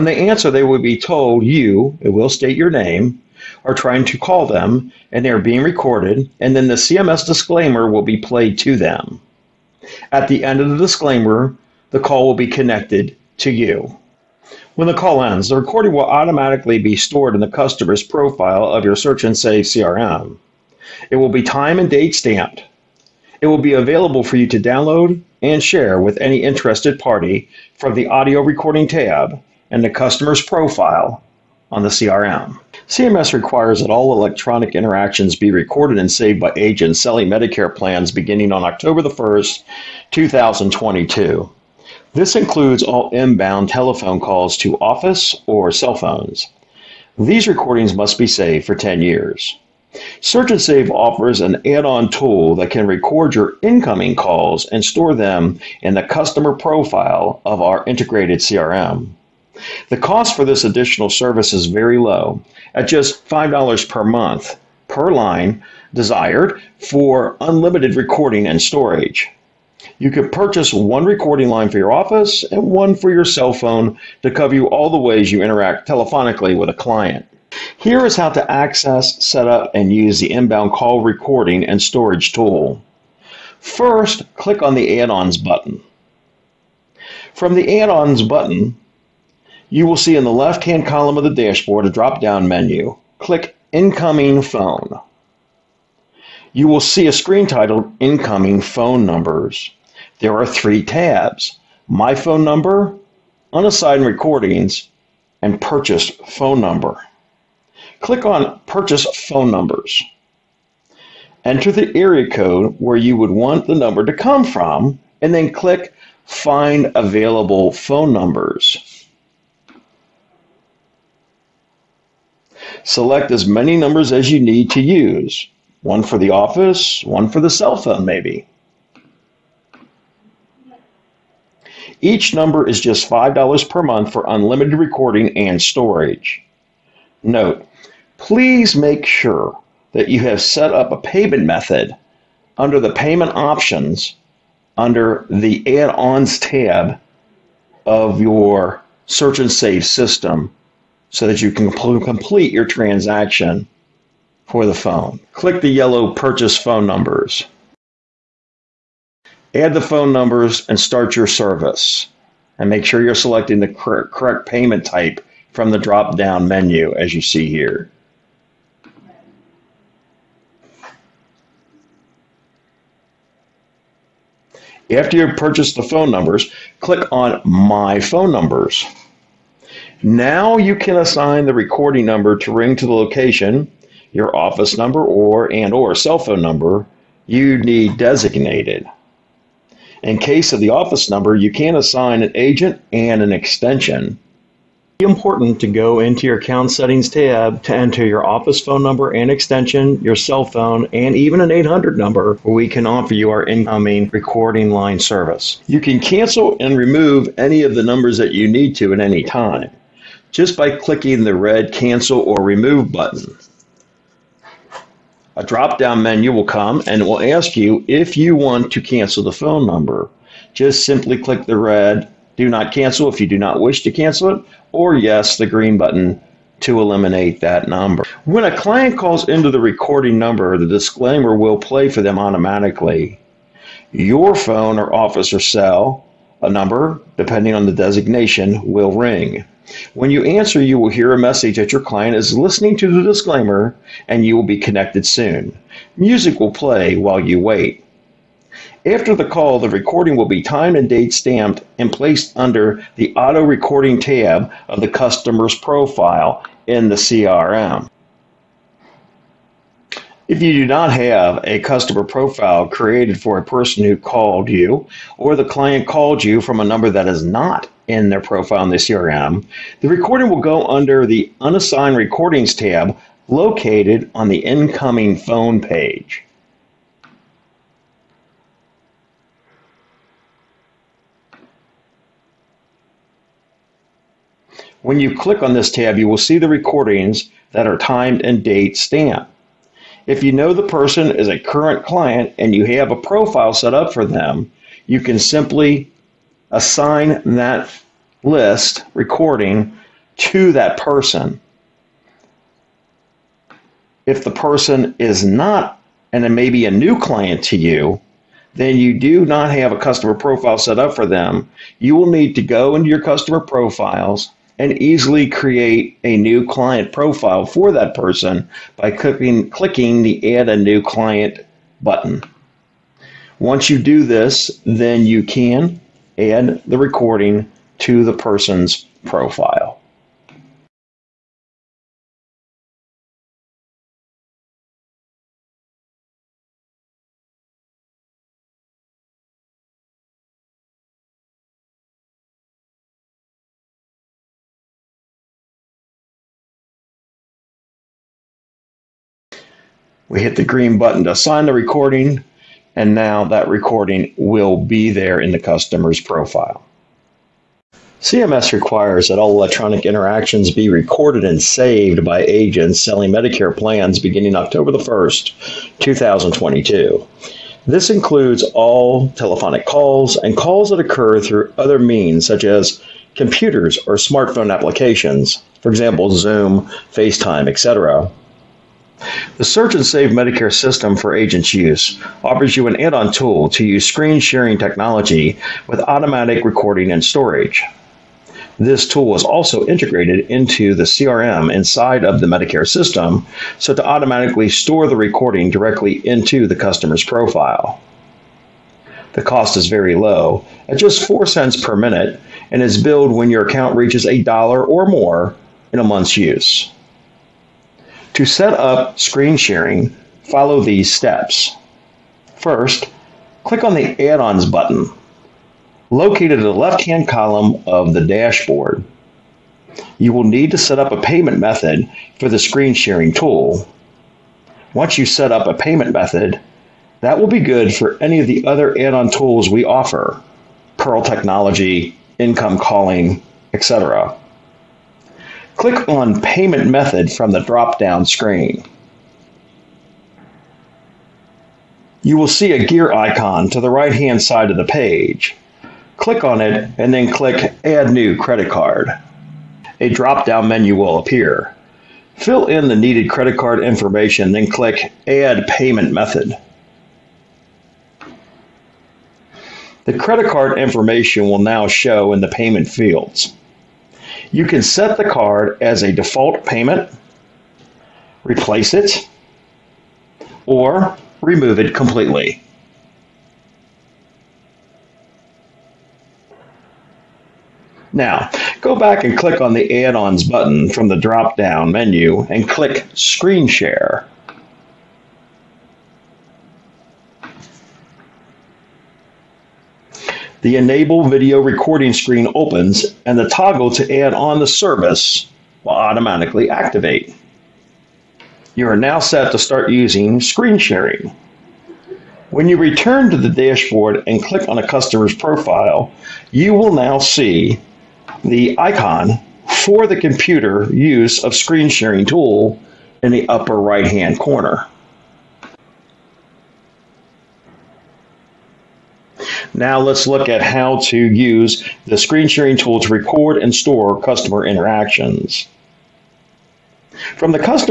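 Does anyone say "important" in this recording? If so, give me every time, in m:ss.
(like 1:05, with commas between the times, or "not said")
3:15.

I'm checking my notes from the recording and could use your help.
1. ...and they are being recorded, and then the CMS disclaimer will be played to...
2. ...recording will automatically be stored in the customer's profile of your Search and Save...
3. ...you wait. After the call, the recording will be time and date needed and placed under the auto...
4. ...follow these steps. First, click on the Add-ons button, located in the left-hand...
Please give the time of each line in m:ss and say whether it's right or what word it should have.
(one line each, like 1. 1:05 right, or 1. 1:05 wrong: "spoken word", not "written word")
1. 0:05 right
2. 0:15 right
3. 4:07 wrong: "stamped", not "needed"
4. 6:50 right.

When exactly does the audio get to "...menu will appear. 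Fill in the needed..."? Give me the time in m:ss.
7:30.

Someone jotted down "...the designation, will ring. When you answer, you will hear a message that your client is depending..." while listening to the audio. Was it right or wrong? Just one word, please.
wrong.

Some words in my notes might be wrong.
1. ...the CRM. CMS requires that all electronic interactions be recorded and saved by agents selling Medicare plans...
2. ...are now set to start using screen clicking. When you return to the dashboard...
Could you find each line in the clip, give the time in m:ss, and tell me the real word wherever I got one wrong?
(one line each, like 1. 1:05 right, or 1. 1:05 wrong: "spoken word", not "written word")
1. 0:31 right
2. 8:18 wrong: "sharing", not "clicking".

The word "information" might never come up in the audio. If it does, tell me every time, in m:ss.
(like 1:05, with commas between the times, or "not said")
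7:33, 7:40.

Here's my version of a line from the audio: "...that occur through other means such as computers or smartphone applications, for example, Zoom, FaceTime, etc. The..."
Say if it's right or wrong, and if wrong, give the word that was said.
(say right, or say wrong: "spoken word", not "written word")
right.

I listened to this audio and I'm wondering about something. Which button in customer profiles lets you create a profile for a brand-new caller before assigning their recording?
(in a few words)
Add a New Client.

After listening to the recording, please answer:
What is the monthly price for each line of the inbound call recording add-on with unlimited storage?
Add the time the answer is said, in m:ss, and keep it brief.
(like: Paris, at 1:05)
$5, at 1:03.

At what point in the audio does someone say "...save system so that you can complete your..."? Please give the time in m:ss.
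2:29.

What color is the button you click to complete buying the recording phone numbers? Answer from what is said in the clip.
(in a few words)
Yellow.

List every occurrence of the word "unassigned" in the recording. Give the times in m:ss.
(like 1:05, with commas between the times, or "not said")
1:43, 4:31.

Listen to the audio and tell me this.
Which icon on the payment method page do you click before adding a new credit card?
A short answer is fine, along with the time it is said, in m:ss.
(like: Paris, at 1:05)
Gear icon, at 7:22.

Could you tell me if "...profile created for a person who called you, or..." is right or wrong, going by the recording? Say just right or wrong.
right.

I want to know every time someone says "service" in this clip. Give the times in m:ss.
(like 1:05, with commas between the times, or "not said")
1:01, 2:41, 3:24, 8:14.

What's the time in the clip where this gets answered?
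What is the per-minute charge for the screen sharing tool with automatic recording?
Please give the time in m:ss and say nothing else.
6:41.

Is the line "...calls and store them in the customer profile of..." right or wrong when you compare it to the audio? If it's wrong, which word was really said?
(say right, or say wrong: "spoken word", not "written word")
right.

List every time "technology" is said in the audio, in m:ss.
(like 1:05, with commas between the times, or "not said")
6:24, 7:11.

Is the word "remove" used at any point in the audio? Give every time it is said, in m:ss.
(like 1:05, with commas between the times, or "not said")
3:26, 3:32, 7:51.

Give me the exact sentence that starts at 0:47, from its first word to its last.
These recordings must be saved for 10 years.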